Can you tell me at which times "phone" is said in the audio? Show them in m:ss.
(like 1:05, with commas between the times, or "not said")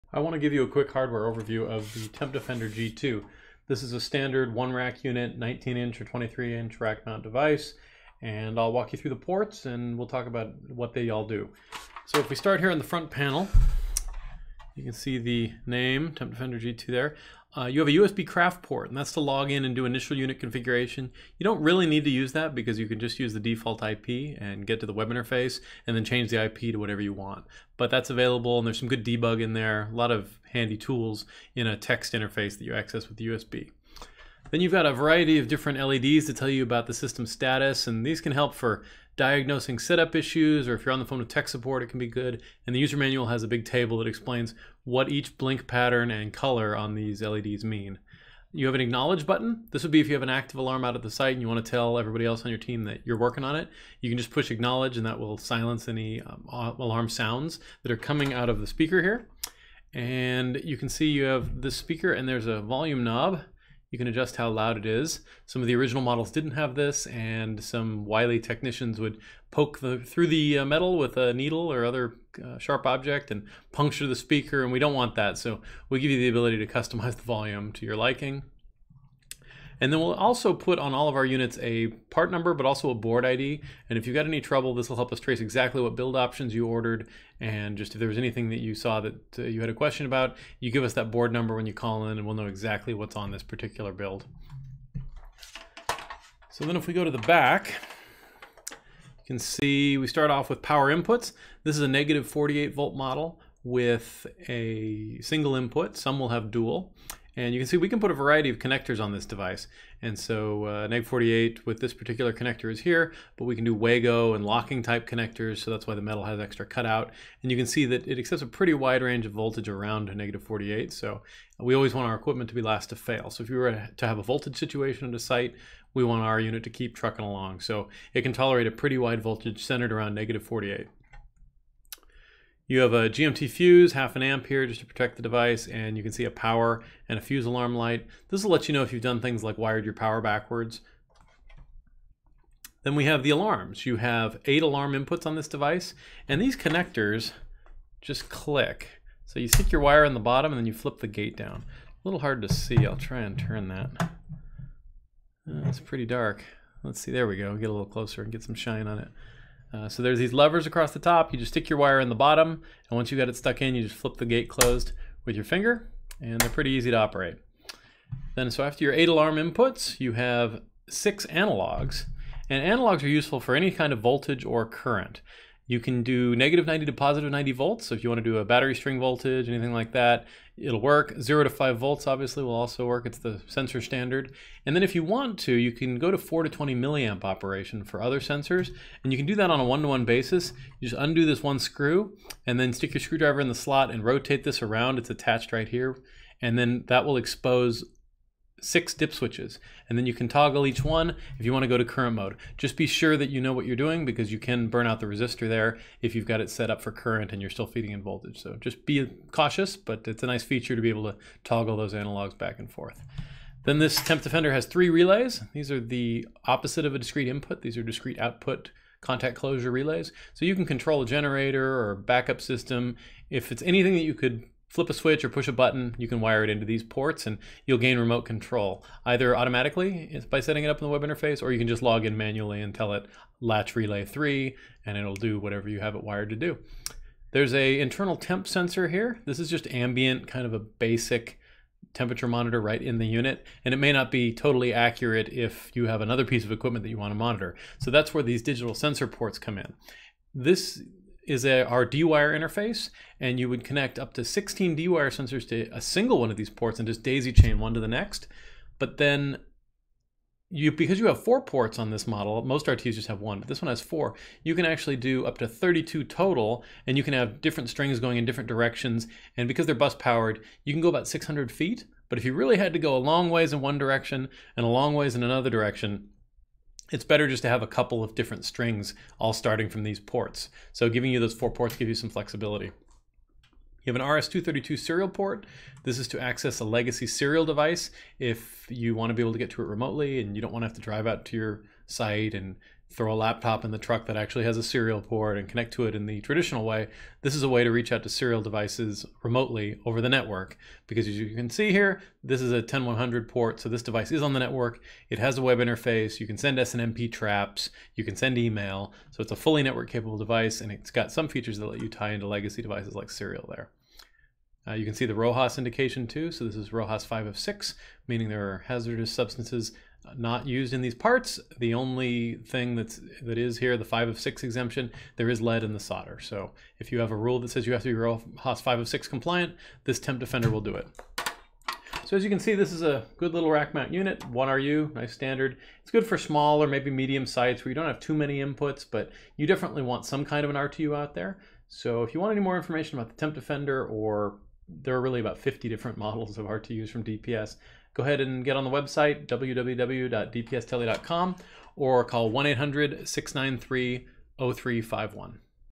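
0:41.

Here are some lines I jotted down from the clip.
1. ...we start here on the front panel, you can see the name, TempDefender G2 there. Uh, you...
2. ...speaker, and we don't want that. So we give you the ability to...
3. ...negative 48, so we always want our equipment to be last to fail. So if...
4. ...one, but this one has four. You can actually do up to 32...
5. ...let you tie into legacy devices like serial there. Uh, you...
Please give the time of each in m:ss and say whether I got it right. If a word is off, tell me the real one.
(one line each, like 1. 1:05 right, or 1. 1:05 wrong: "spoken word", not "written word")
1. 0:12 right
2. 1:14 right
3. 2:00 right
4. 4:23 right
5. 5:11 right.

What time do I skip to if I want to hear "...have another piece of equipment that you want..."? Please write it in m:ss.
4:05.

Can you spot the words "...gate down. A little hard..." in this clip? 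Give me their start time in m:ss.
2:31.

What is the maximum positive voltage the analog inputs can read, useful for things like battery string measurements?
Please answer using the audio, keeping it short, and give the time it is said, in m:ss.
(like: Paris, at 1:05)
90 volts, at 2:56.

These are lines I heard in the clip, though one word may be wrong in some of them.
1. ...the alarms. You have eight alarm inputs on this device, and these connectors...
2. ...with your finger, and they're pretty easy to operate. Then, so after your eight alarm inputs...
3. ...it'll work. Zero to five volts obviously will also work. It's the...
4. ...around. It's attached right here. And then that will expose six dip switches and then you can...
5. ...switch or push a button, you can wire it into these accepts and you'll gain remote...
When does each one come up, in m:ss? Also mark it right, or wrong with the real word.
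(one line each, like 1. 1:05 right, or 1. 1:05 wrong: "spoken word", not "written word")
1. 2:23 right
2. 2:45 right
3. 3:00 right
4. 3:14 right
5. 3:44 wrong: "ports", not "accepts".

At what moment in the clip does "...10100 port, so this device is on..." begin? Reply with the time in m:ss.
5:02.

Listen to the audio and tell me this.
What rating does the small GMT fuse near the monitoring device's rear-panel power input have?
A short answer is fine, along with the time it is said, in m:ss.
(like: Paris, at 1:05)
half an amp, at 2:13.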